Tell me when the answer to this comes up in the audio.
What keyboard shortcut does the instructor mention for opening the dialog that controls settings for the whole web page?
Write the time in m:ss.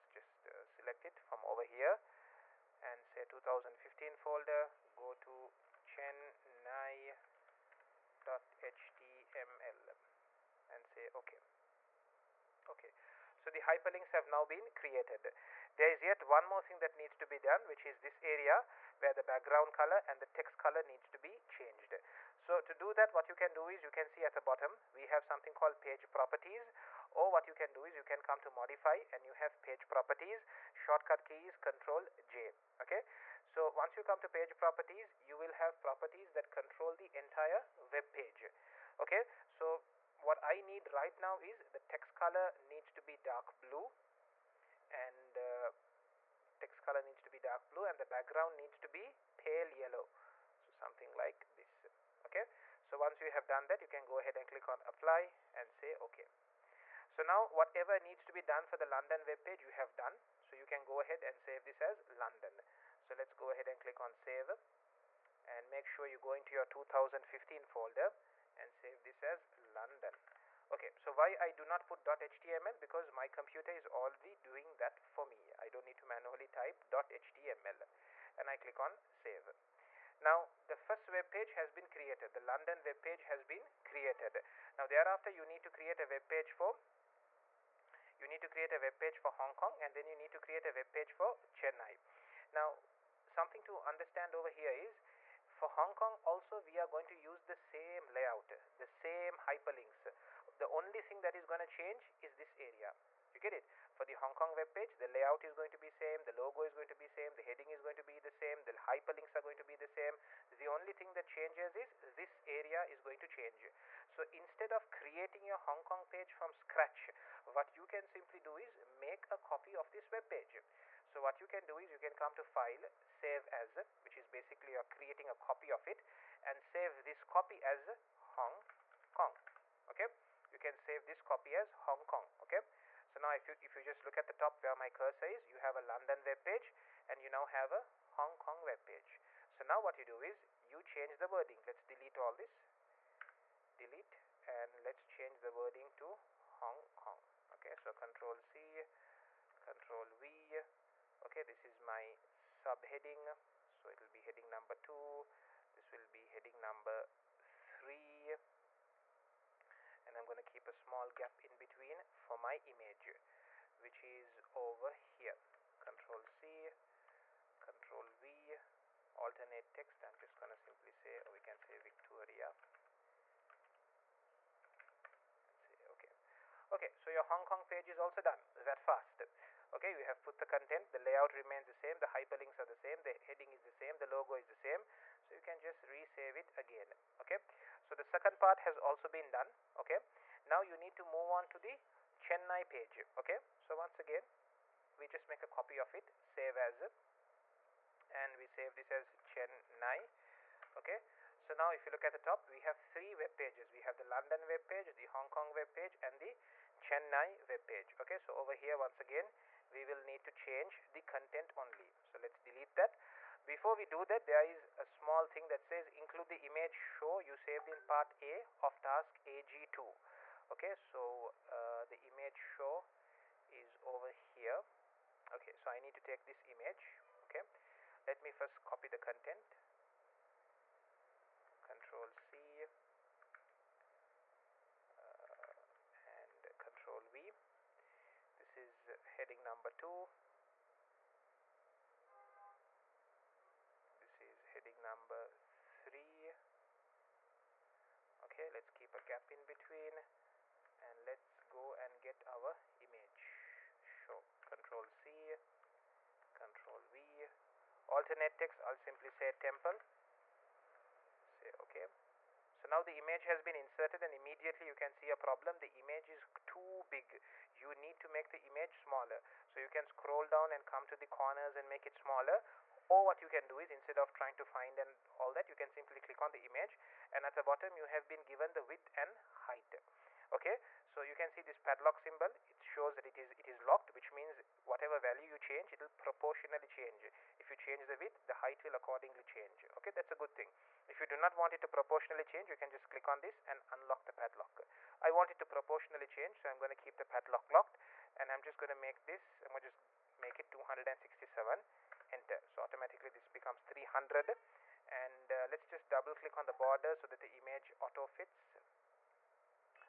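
0:31.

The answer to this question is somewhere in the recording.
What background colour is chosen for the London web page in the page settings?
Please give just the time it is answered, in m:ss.
0:49.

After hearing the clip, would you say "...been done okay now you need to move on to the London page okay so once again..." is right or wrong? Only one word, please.
wrong.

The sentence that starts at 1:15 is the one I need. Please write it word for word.
I don't need to manually type .html and I click on save.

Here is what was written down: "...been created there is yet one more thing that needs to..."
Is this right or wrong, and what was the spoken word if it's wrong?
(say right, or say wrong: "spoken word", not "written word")
right.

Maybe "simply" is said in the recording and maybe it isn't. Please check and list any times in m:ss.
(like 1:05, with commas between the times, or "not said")
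1:58, 2:50, 4:18, 4:35.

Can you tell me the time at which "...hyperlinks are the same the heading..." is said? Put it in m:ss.
3:02.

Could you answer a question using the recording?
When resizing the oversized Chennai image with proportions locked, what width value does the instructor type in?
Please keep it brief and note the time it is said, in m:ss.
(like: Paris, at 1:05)
267, at 5:00.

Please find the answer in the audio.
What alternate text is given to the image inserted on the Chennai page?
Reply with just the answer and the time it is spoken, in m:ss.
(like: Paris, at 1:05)
temple, at 4:19.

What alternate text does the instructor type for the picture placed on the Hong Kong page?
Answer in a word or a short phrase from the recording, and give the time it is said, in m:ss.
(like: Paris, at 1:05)
Victoria, at 2:51.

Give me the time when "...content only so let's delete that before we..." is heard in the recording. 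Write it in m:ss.
3:31.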